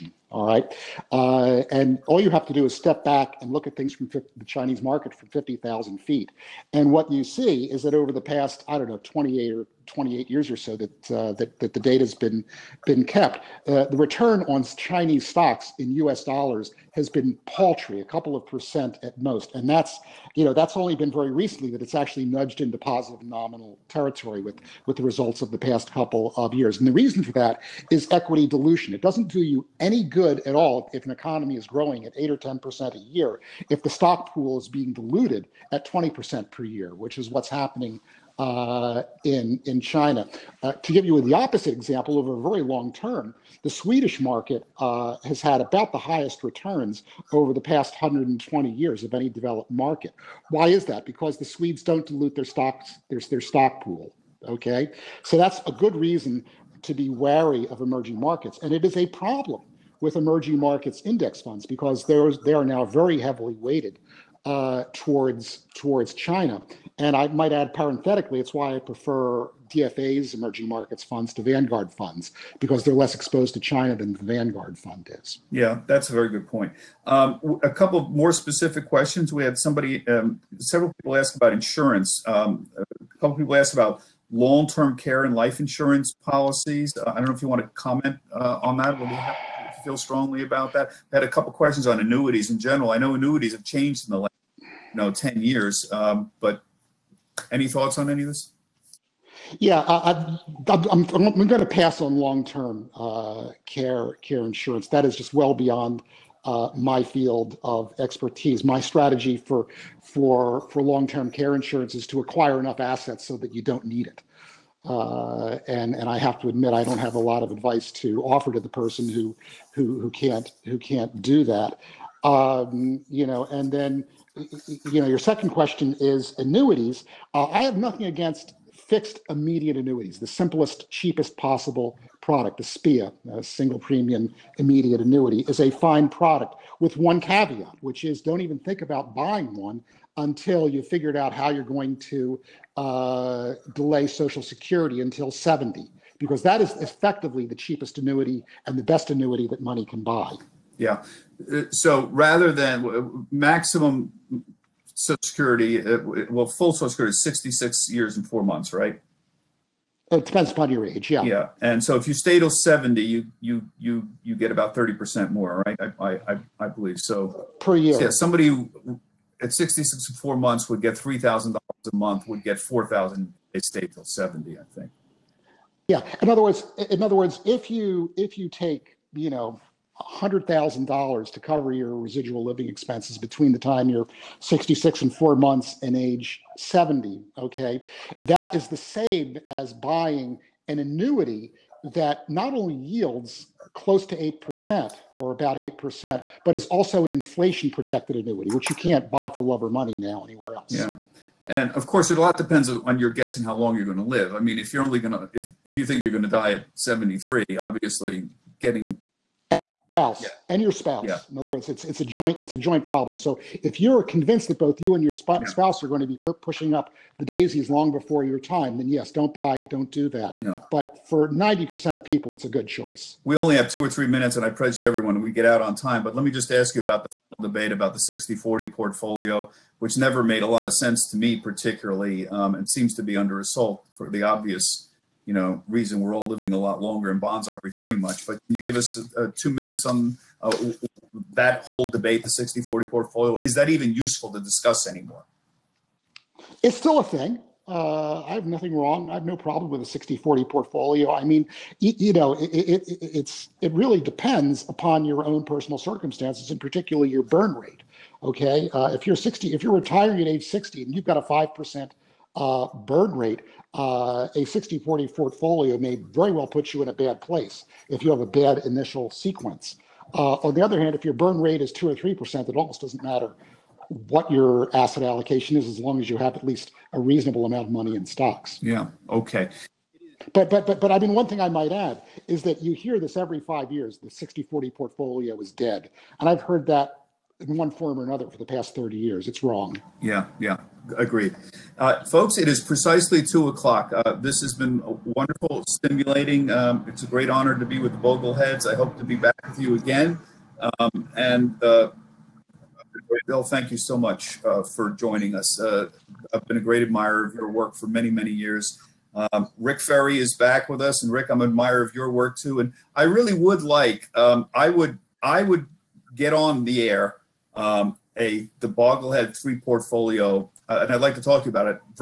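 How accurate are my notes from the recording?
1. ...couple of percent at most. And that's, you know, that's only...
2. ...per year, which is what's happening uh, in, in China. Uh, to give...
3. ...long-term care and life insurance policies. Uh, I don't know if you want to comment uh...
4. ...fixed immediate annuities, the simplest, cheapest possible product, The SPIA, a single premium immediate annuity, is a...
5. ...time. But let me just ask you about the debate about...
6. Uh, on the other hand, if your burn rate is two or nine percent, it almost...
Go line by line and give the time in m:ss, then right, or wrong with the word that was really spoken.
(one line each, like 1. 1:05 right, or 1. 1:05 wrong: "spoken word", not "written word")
1. 0:18 right
2. 0:36 right
3. 1:24 right
4. 2:08 right
5. 3:45 right
6. 4:30 wrong: "three", not "nine".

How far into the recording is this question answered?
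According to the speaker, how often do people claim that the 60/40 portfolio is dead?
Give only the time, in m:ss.
4:43.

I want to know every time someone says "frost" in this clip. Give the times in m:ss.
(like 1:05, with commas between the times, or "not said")
not said.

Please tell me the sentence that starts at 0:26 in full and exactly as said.
And the reason for that is equity dilution.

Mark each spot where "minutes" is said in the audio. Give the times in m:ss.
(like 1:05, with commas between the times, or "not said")
3:44, 3:59.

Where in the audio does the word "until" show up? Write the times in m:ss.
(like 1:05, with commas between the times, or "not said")
2:20, 2:25.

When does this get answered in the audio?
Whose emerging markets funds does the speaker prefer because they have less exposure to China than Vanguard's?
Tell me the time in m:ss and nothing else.
1:09.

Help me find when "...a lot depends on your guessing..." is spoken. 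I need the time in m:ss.
3:22.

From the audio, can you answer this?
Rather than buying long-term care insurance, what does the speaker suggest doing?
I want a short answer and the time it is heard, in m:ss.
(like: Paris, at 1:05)
Acquire enough assets, at 1:52.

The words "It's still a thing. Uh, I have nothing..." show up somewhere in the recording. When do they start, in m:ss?
4:06.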